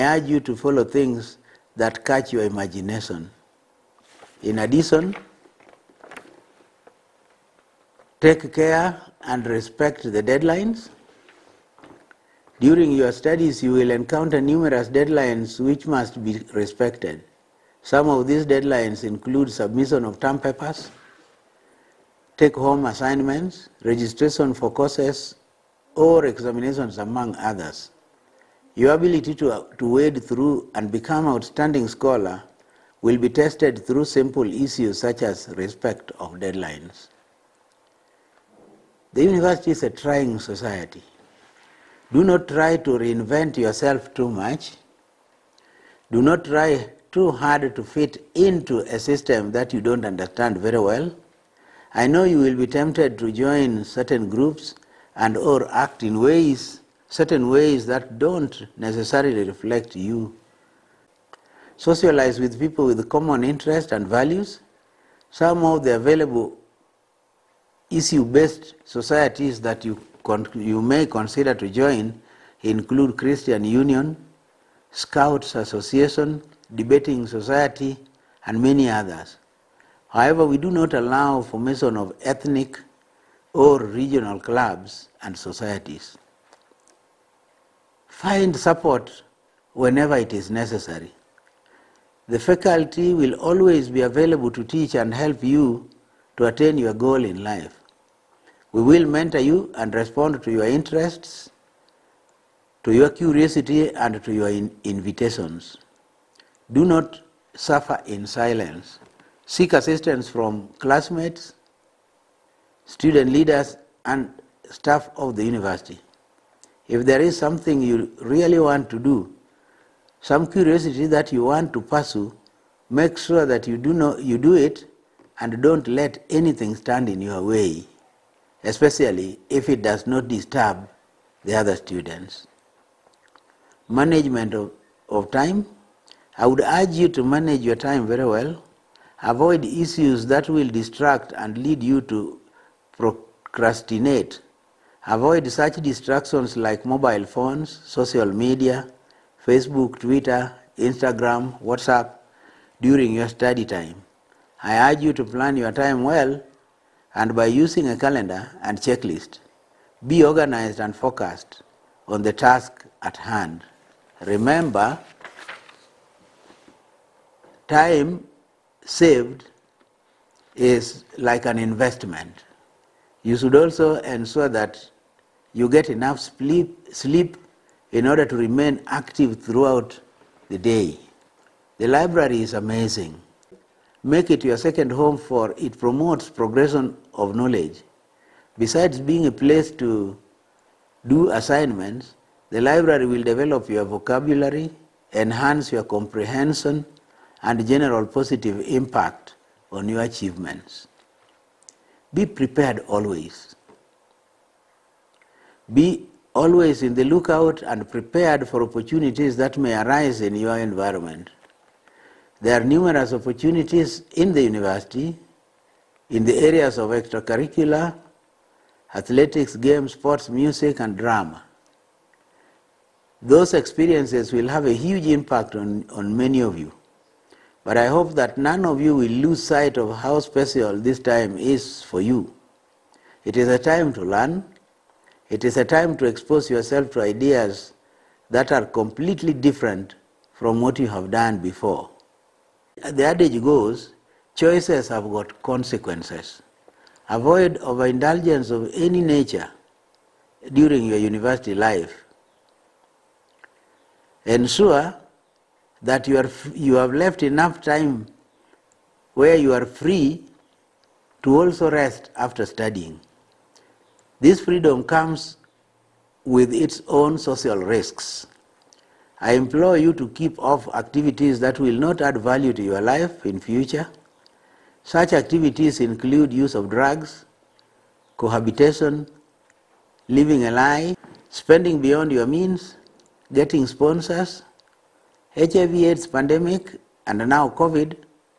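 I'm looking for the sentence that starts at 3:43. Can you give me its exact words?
Those experiences will have a huge impact on, on many of you.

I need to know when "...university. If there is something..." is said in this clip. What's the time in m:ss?
1:55.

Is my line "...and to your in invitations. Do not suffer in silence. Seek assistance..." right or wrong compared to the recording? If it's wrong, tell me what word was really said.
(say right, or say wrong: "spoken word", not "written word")
right.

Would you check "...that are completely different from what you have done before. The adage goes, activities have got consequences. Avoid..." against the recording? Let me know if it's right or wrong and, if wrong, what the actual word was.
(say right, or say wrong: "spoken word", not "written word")
wrong: "choices", not "activities".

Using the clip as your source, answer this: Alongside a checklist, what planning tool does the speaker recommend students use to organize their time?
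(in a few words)
A calendar.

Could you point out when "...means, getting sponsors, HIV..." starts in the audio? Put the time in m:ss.
4:42.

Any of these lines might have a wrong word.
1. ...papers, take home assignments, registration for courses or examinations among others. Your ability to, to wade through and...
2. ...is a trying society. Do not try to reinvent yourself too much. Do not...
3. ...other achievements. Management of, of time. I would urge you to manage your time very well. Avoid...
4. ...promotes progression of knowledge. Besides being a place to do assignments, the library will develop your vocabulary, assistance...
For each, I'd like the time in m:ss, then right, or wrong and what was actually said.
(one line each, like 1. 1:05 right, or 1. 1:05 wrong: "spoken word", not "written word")
1. 0:20 right
2. 0:39 right
3. 2:11 wrong: "students", not "achievements"
4. 3:05 wrong: "enhance", not "assistance".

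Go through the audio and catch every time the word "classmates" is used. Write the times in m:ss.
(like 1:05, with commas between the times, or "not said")
1:50.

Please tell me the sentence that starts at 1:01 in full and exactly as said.
Socialize with people with common interests and values.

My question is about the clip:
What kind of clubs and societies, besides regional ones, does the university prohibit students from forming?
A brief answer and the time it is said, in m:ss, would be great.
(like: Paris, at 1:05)
Ethnic, at 1:22.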